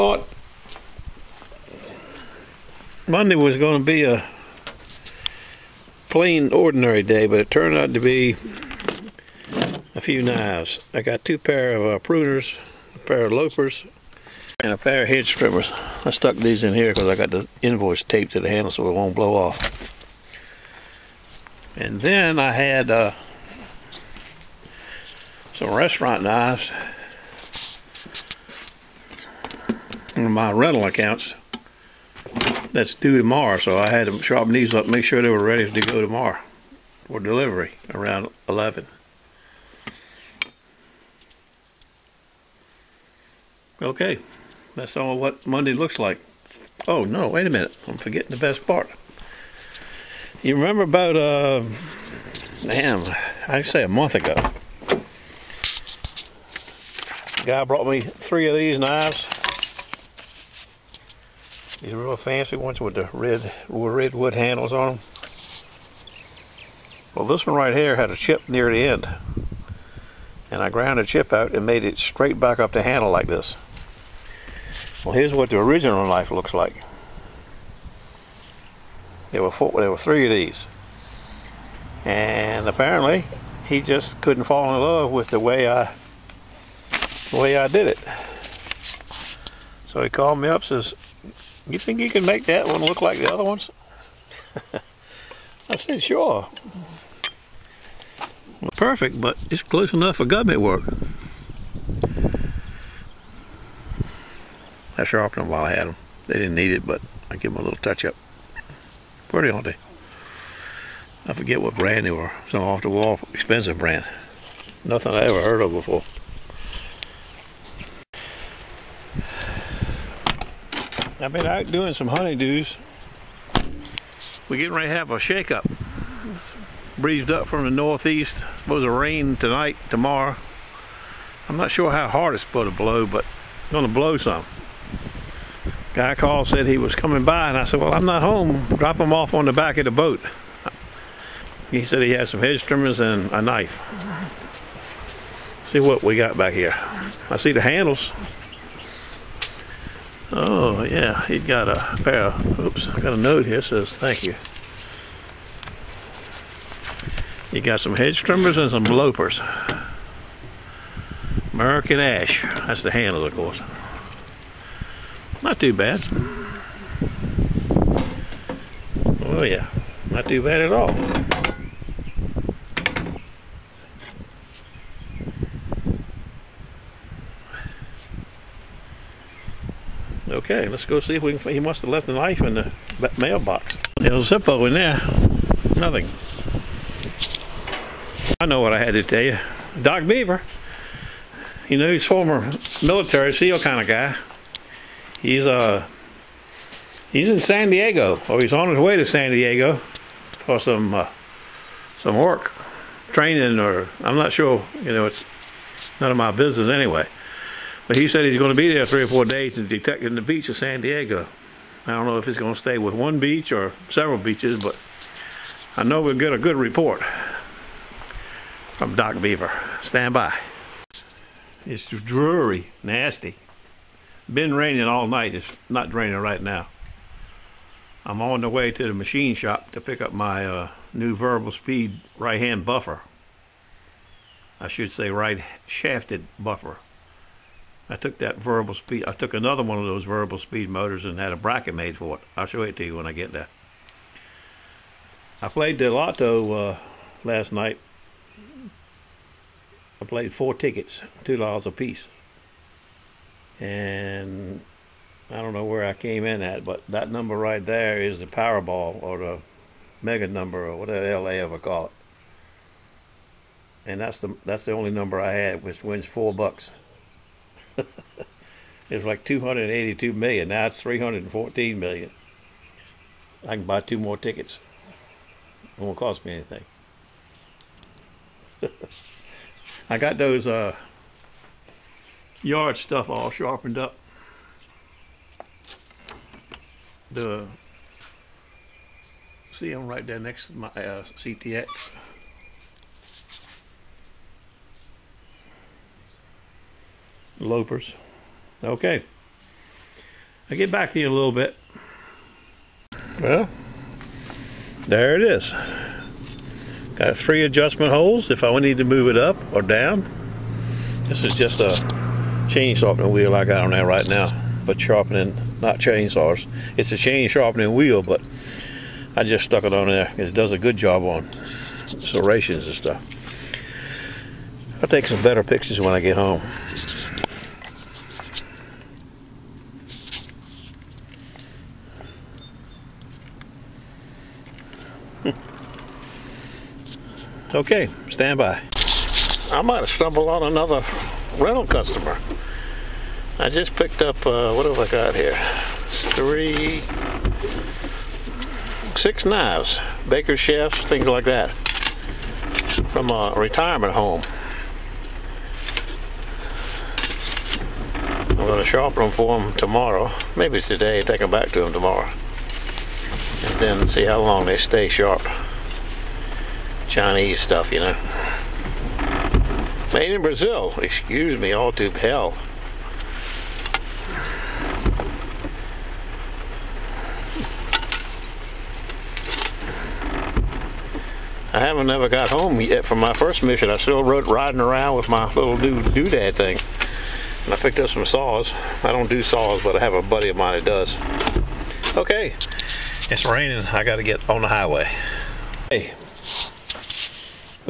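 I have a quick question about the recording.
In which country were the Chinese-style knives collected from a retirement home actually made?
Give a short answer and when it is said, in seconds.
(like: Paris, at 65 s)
Brazil, at 370 s.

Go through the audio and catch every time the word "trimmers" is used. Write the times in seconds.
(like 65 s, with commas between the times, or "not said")
15 s, 142 s, 158 s.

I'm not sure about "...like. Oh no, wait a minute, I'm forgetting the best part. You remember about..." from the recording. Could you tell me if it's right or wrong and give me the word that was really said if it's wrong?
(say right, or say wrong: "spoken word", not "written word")
right.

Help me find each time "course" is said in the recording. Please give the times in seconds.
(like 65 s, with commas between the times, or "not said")
163 s.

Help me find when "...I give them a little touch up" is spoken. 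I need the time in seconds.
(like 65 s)
107 s.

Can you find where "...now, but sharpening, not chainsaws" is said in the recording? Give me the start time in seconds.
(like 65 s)
314 s.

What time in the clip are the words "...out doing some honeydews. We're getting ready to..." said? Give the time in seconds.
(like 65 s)
121 s.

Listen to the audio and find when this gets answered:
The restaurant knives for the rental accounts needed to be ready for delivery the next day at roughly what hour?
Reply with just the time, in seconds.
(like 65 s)
38 s.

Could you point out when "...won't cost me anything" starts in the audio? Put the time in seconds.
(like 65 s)
275 s.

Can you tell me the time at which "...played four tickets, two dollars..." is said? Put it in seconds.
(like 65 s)
250 s.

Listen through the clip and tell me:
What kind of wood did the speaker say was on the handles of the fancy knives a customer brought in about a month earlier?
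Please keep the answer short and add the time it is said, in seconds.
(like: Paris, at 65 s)
redwood, at 63 s.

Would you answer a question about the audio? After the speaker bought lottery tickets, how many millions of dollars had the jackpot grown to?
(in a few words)
314 million.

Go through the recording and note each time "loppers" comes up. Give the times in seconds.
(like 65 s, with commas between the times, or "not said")
158 s, 297 s.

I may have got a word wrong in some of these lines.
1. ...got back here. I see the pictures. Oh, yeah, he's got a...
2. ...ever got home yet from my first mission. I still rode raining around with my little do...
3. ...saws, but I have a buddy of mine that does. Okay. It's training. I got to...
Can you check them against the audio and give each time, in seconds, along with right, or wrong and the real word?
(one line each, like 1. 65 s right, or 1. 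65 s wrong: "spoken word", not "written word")
1. 146 s wrong: "handles", not "pictures"
2. 381 s wrong: "riding", not "raining"
3. 389 s wrong: "raining", not "training".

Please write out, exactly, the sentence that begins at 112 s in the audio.
Some off the wall, expensive brand.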